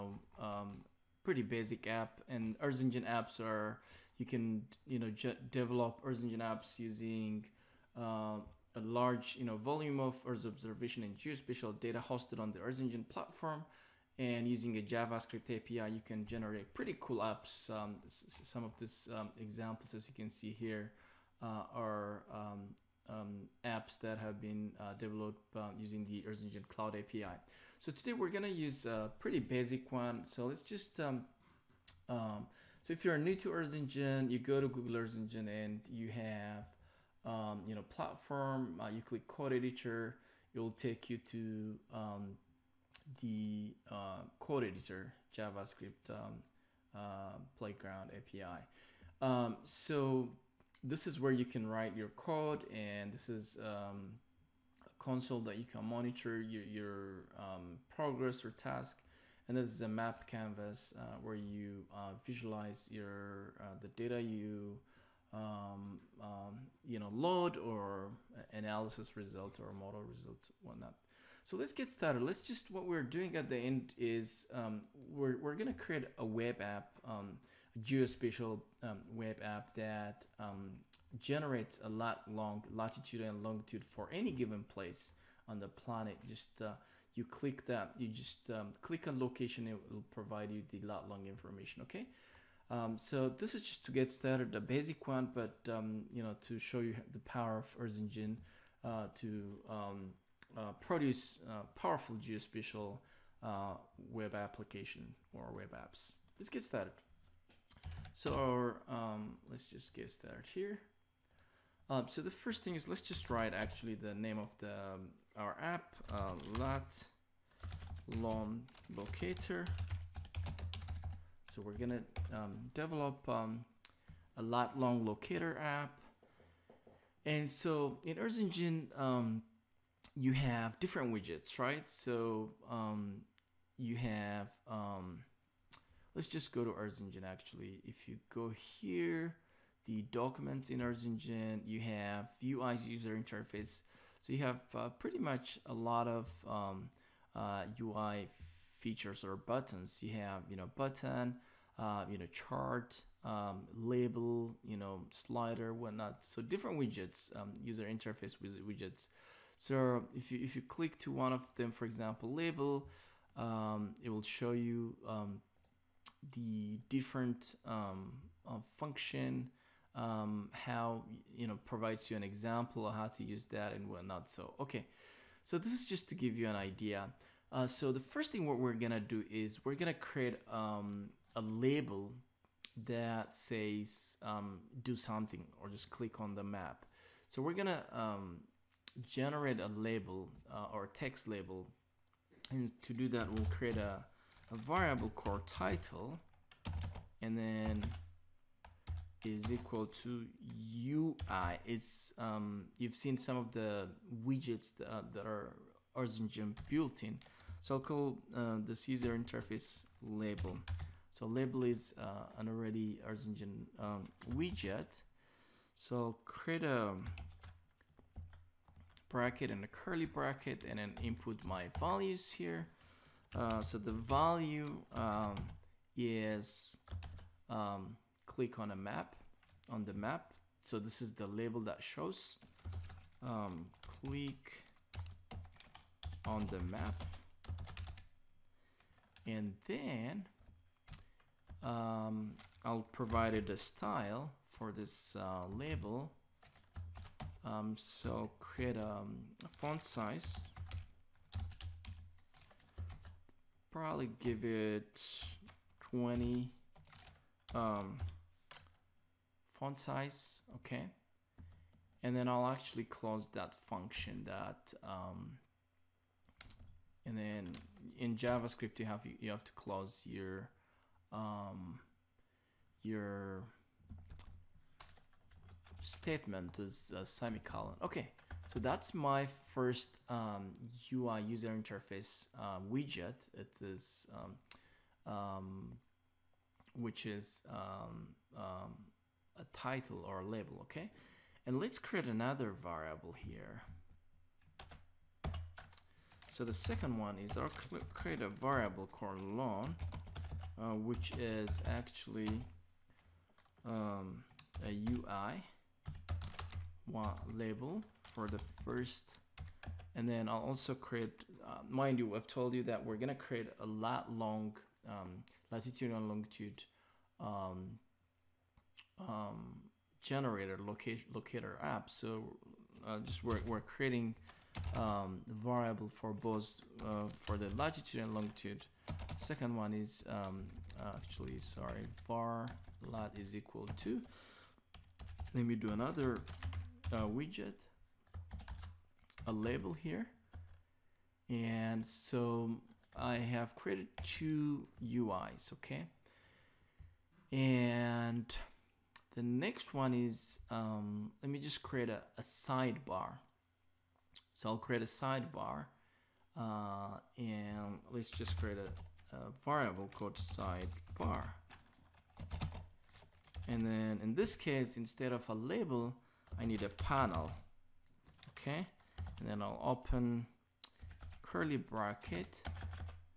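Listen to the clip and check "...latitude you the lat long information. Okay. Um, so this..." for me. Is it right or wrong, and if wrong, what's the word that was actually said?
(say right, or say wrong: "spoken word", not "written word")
wrong: "provide", not "latitude".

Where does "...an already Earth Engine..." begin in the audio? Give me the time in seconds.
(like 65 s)
212 s.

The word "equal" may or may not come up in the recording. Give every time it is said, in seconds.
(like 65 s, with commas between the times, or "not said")
199 s, 333 s.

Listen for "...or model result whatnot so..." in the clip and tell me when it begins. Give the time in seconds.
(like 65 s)
69 s.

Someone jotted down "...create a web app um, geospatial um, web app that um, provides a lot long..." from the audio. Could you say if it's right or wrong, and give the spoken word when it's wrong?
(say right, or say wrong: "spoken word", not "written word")
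wrong: "generates", not "provides".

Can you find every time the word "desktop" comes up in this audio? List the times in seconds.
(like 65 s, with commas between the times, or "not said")
not said.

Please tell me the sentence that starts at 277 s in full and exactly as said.
Okay, so that's my first um, UI user interface uh, widget.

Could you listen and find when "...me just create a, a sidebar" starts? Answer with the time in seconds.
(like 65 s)
351 s.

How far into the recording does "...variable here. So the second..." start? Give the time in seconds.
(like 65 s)
292 s.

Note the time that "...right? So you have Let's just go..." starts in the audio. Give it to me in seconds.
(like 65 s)
131 s.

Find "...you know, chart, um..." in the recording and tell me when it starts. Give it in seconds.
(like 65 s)
152 s.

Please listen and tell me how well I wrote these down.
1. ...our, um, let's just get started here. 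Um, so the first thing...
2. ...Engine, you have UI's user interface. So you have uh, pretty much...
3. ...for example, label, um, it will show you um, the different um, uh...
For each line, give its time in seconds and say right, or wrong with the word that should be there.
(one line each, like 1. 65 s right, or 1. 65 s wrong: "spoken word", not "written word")
1. 108 s right
2. 141 s right
3. 161 s right.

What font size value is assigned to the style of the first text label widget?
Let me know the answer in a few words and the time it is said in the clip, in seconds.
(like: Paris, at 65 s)
20, at 255 s.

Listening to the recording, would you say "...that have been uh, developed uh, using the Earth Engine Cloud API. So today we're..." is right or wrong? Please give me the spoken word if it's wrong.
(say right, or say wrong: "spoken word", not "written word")
right.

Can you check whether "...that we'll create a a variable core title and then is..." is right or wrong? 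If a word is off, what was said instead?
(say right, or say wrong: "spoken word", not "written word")
right.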